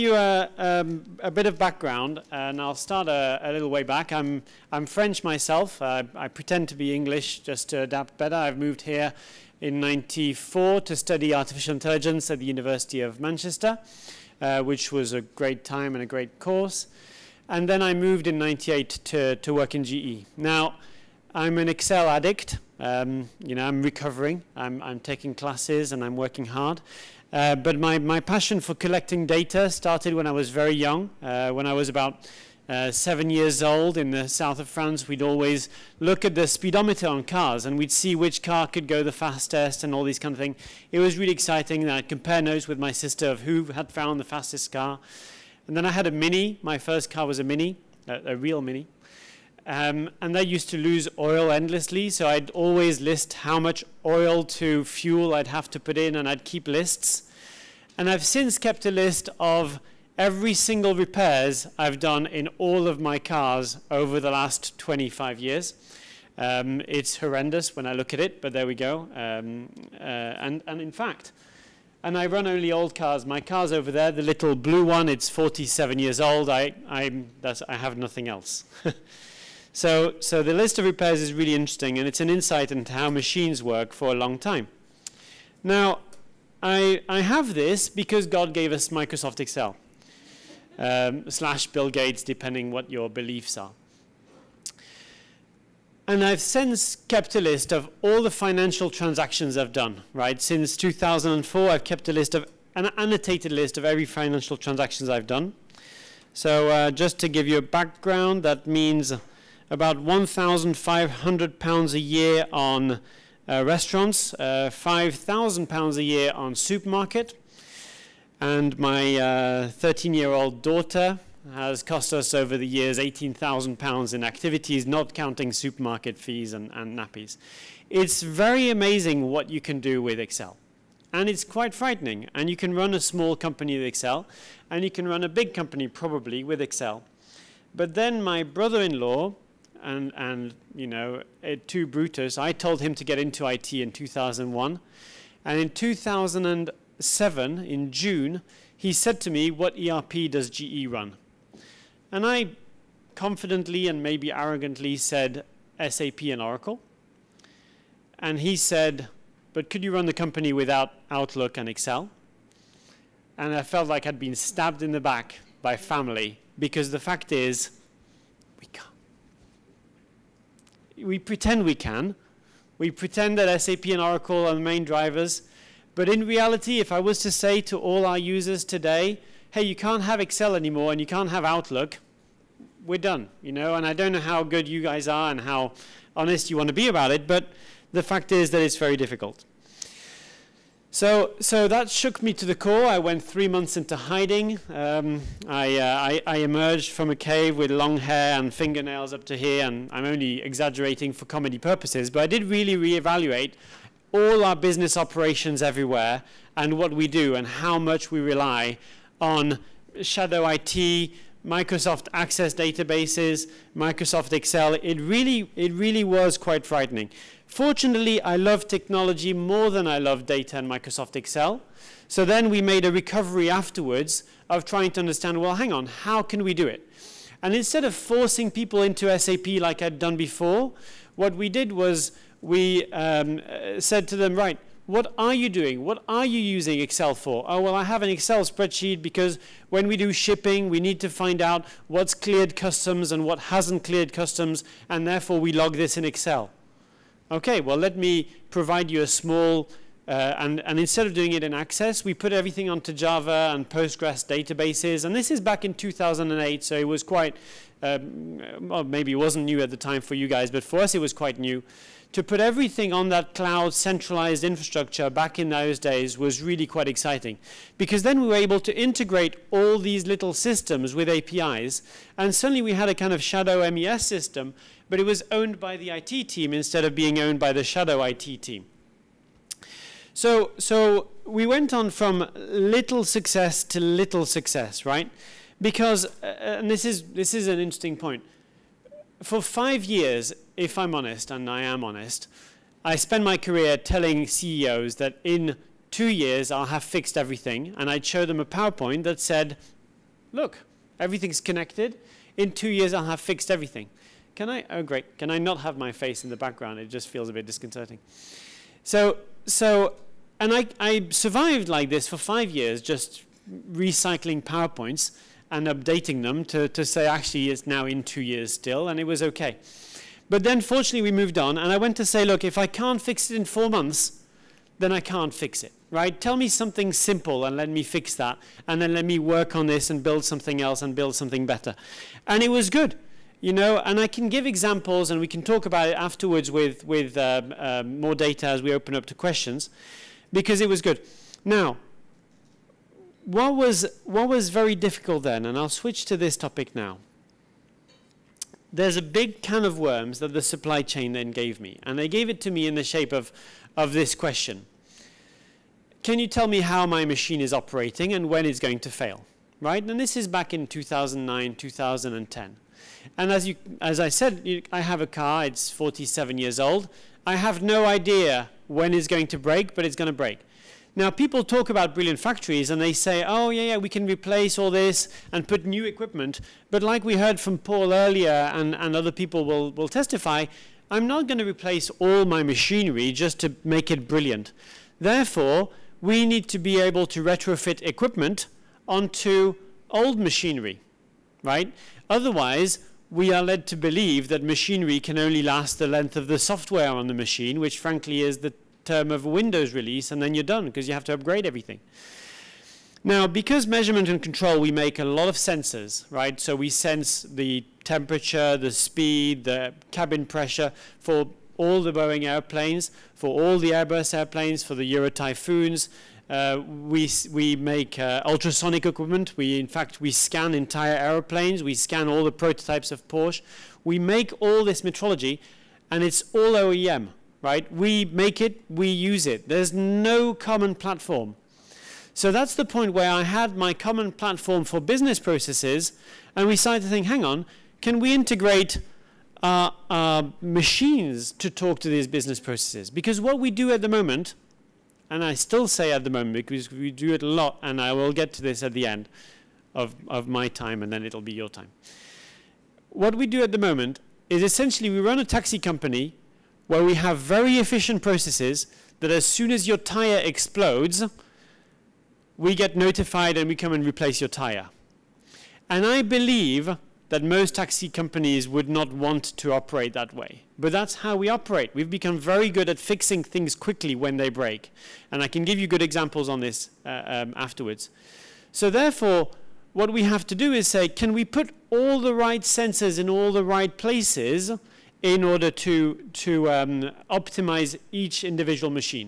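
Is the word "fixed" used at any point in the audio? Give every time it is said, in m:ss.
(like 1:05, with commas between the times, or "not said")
4:56, 5:03.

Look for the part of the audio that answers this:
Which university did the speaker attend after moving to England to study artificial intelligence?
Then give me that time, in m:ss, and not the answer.
0:12.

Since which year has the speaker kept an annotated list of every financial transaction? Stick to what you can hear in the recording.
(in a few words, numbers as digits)
2004.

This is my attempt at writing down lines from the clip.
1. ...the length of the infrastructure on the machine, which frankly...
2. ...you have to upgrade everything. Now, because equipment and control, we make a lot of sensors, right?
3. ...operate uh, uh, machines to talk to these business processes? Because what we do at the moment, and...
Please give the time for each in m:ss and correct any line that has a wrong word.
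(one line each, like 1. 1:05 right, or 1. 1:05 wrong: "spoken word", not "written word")
1. 6:35 wrong: "software", not "infrastructure"
2. 6:40 wrong: "measurement", not "equipment"
3. 7:18 wrong: "integrate", not "operate".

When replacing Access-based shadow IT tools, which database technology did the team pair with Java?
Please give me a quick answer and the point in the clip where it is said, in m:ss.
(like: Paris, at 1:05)
Postgres, at 4:13.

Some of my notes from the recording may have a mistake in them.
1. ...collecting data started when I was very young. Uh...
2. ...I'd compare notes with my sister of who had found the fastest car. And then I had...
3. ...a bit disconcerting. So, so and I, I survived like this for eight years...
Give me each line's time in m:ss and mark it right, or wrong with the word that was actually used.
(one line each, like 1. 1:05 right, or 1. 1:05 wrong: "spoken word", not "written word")
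1. 0:28 right
2. 0:41 right
3. 5:07 wrong: "five", not "eight".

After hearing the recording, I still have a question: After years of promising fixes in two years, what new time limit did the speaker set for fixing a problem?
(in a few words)
4 months.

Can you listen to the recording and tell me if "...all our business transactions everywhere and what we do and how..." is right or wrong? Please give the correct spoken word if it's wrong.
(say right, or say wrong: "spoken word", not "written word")
wrong: "operations", not "transactions".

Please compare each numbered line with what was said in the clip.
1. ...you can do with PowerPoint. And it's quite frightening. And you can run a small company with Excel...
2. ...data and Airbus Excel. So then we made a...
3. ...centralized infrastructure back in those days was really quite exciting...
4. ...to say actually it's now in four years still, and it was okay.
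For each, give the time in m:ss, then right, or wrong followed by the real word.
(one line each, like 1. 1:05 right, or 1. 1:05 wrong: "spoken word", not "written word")
1. 2:09 wrong: "Excel", not "PowerPoint"
2. 3:40 wrong: "Microsoft", not "Airbus"
3. 4:23 right
4. 5:16 wrong: "two", not "four".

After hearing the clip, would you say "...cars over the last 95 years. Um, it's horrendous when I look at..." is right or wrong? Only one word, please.
wrong.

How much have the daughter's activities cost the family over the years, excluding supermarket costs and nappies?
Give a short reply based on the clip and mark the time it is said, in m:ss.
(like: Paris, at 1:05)
£18,000, at 2:02.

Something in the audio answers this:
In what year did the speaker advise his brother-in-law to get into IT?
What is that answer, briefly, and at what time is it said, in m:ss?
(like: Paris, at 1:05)
2001, at 2:23.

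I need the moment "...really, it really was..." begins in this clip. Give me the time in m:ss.
3:34.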